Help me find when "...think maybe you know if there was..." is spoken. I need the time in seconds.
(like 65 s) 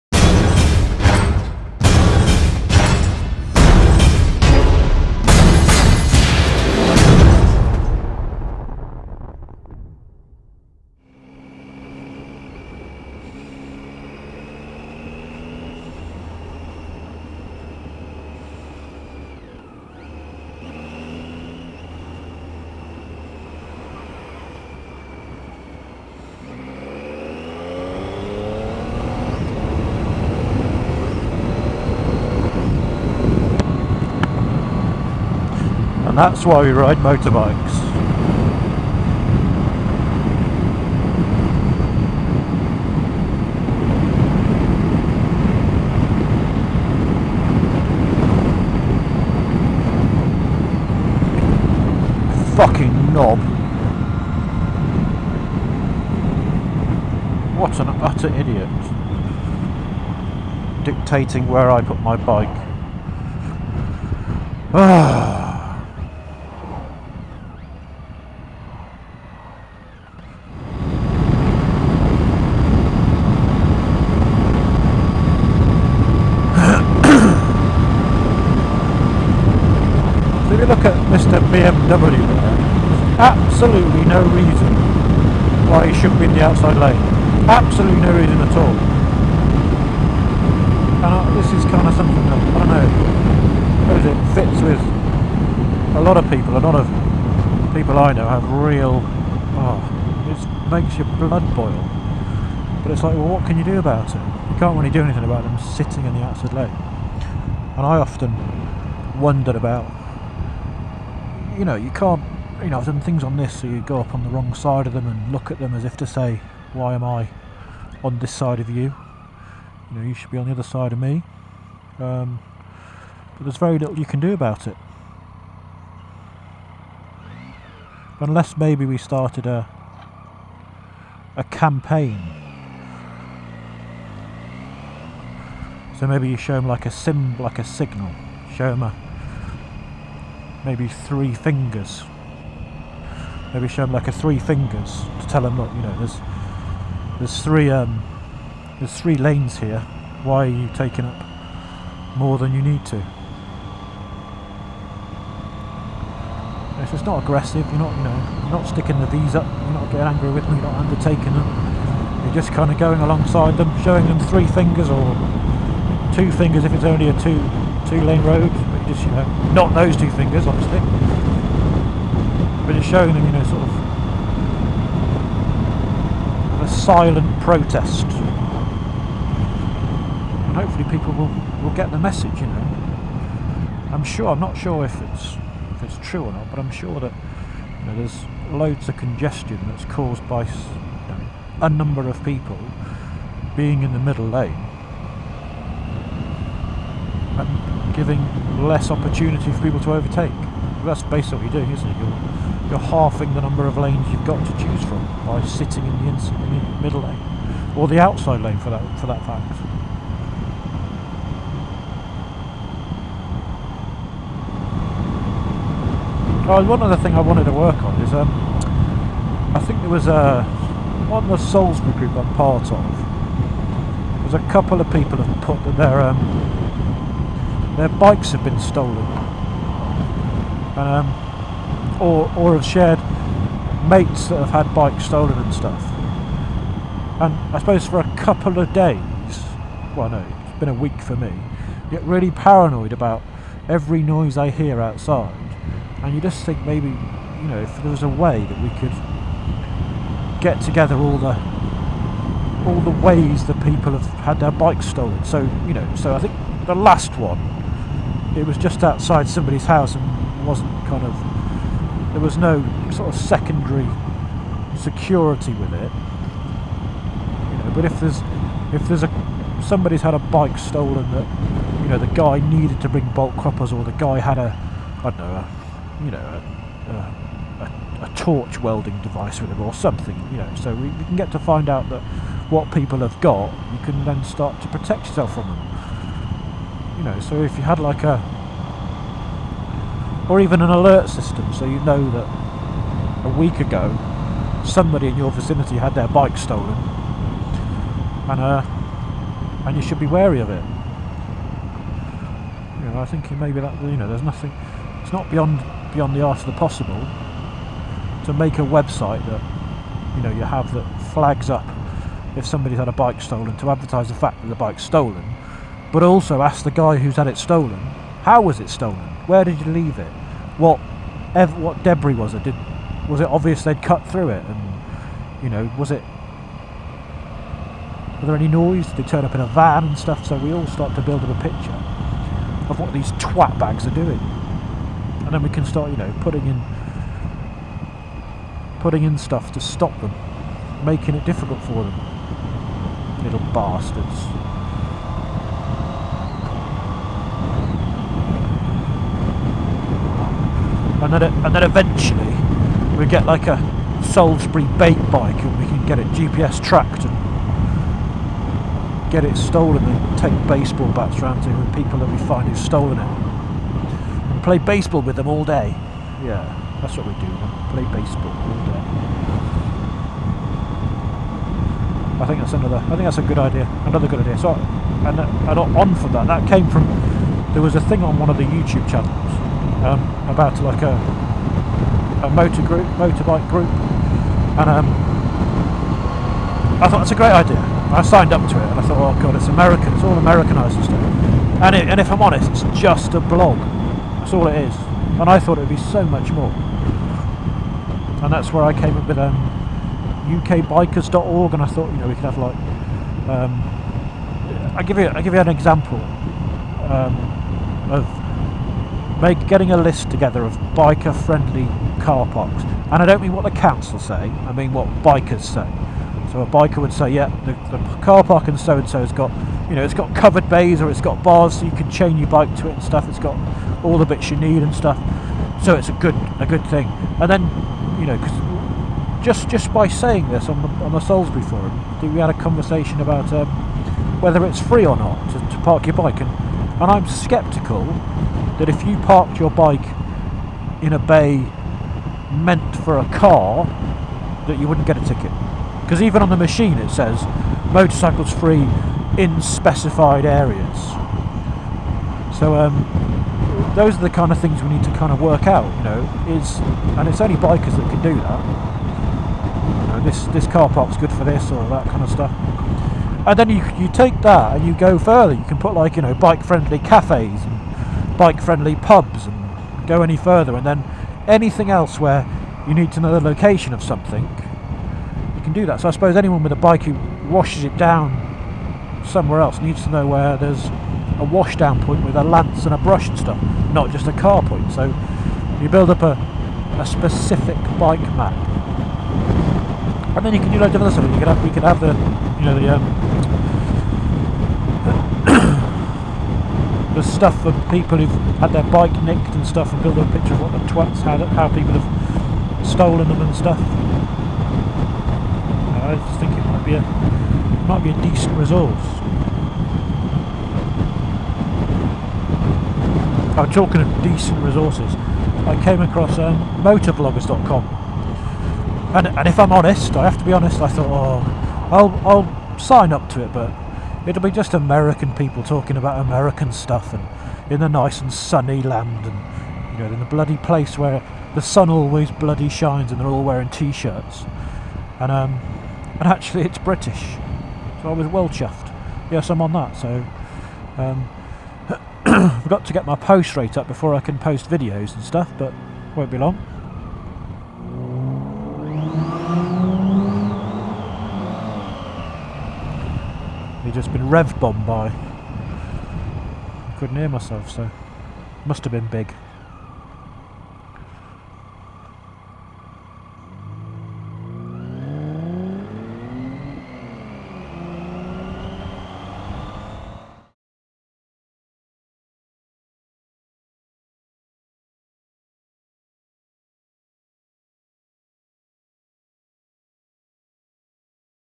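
246 s.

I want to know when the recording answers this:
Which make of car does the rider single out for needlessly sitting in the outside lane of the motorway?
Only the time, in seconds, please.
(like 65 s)
81 s.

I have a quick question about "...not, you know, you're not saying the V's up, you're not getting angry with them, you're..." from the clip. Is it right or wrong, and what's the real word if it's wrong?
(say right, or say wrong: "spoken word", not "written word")
wrong: "sticking", not "saying".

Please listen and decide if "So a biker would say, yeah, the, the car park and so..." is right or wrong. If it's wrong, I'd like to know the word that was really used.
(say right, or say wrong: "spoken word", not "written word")
right.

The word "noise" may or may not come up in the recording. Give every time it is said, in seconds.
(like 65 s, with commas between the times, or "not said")
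244 s, 328 s.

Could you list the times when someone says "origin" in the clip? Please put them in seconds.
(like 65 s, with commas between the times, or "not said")
not said.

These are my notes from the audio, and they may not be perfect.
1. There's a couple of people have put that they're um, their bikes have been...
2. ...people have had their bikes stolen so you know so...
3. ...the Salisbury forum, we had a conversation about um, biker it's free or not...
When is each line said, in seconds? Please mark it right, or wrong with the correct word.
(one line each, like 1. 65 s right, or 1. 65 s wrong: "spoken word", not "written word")
1. 224 s right
2. 253 s right
3. 430 s wrong: "whether", not "biker".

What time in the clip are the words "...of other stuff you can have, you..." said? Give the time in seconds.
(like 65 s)
490 s.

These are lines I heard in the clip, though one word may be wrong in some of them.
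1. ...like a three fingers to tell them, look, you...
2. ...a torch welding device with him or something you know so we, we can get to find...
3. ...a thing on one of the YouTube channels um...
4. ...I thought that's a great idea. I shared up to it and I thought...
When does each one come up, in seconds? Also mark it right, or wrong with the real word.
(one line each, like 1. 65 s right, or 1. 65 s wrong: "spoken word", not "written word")
1. 143 s right
2. 278 s right
3. 377 s right
4. 386 s wrong: "signed", not "shared".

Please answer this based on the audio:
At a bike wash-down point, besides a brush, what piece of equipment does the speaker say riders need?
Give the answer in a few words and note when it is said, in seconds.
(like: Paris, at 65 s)
A lance, at 482 s.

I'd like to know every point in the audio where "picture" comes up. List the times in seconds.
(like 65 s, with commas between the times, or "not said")
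331 s, 500 s.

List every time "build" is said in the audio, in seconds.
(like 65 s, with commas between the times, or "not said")
331 s, 485 s, 499 s.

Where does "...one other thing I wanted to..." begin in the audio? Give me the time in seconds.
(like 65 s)
216 s.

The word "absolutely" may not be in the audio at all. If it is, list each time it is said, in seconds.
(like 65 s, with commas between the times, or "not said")
83 s, 87 s.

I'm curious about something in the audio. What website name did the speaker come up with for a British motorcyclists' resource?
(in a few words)
UKBikers.org.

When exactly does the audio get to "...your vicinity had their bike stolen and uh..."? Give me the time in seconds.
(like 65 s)
295 s.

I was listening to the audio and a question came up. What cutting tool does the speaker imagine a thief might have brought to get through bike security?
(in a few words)
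Bolt croppers.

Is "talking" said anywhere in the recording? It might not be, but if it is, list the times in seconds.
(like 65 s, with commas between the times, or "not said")
513 s, 525 s.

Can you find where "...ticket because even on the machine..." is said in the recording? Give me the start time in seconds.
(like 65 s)
445 s.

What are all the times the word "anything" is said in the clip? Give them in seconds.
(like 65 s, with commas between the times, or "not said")
105 s, 471 s.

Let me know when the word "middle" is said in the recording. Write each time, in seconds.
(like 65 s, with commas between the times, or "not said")
193 s, 206 s.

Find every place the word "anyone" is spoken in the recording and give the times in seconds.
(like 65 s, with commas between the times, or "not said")
476 s.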